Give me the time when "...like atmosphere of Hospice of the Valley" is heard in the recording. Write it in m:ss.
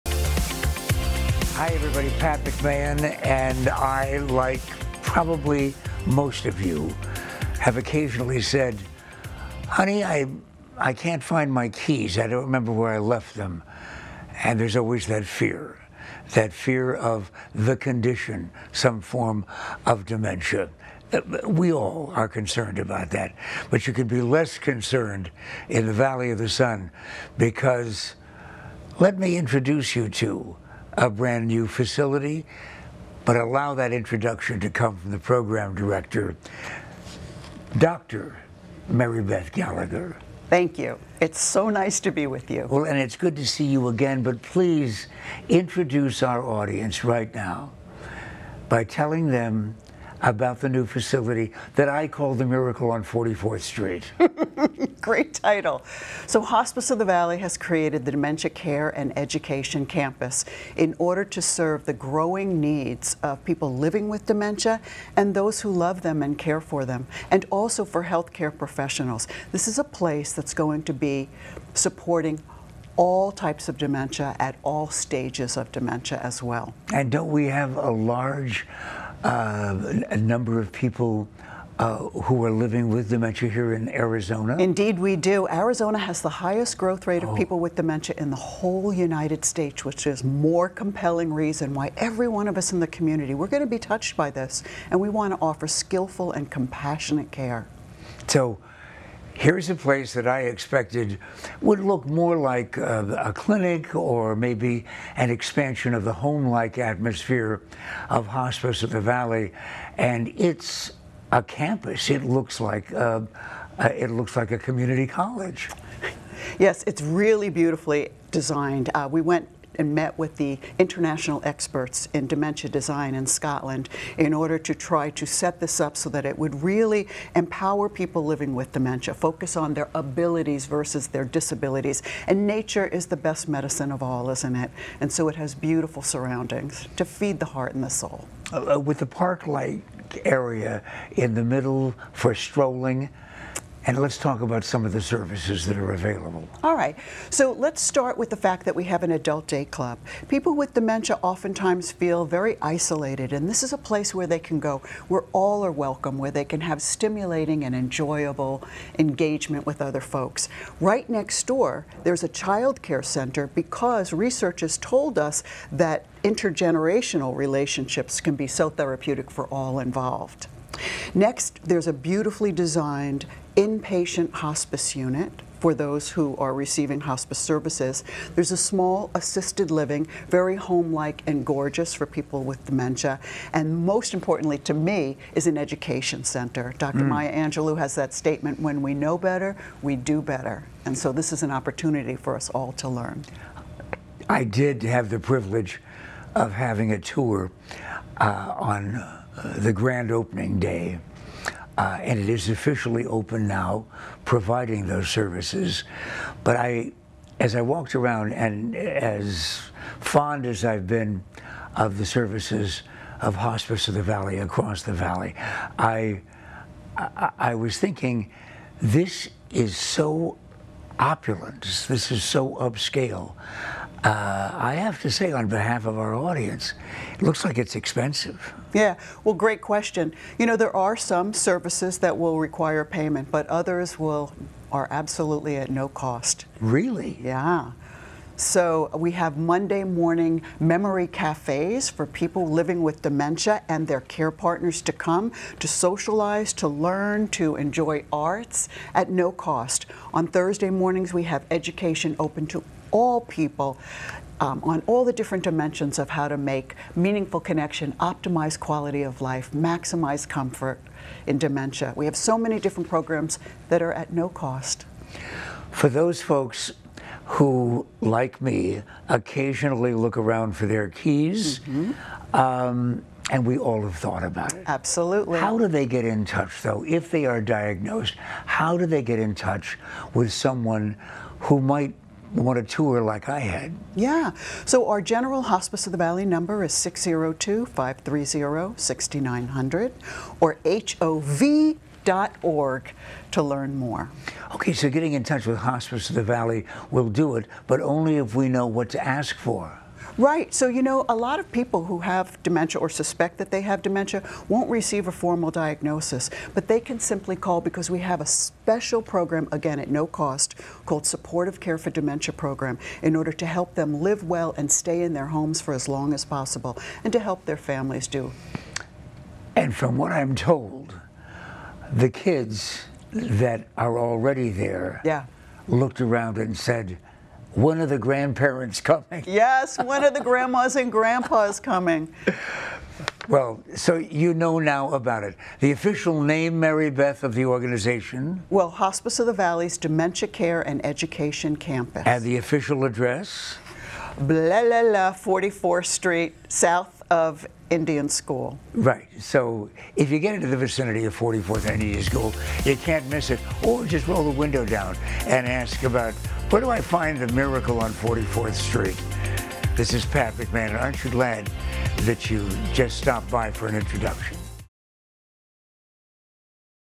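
1:46.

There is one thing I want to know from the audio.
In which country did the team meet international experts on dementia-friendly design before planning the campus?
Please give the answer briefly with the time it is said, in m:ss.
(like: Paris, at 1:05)
Scotland, at 2:03.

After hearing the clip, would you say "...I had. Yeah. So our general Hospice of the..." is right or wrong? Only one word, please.
right.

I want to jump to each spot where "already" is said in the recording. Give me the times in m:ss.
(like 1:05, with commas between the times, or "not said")
5:23.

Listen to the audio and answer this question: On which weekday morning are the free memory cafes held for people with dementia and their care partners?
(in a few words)
Monday.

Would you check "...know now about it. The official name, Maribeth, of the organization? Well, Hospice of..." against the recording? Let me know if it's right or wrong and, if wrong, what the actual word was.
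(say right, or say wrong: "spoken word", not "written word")
right.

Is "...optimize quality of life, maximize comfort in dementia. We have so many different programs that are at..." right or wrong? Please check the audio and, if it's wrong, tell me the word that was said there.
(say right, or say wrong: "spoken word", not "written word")
right.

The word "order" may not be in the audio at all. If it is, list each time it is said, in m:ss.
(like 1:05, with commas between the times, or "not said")
1:00, 2:04, 5:13.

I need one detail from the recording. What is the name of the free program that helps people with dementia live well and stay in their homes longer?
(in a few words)
Supportive Care for Dementia.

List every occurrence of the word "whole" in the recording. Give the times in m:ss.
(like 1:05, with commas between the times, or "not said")
1:28.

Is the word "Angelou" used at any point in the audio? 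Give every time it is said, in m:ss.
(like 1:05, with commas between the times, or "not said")
3:07.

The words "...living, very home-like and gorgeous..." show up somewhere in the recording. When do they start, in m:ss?
2:59.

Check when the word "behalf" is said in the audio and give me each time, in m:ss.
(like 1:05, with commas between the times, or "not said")
3:45.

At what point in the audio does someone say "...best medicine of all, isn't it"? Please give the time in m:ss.
2:13.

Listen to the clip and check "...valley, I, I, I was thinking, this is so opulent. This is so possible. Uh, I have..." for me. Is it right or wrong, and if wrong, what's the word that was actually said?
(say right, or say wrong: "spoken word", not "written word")
wrong: "upscale", not "possible".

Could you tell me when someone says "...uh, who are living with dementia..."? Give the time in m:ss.
1:21.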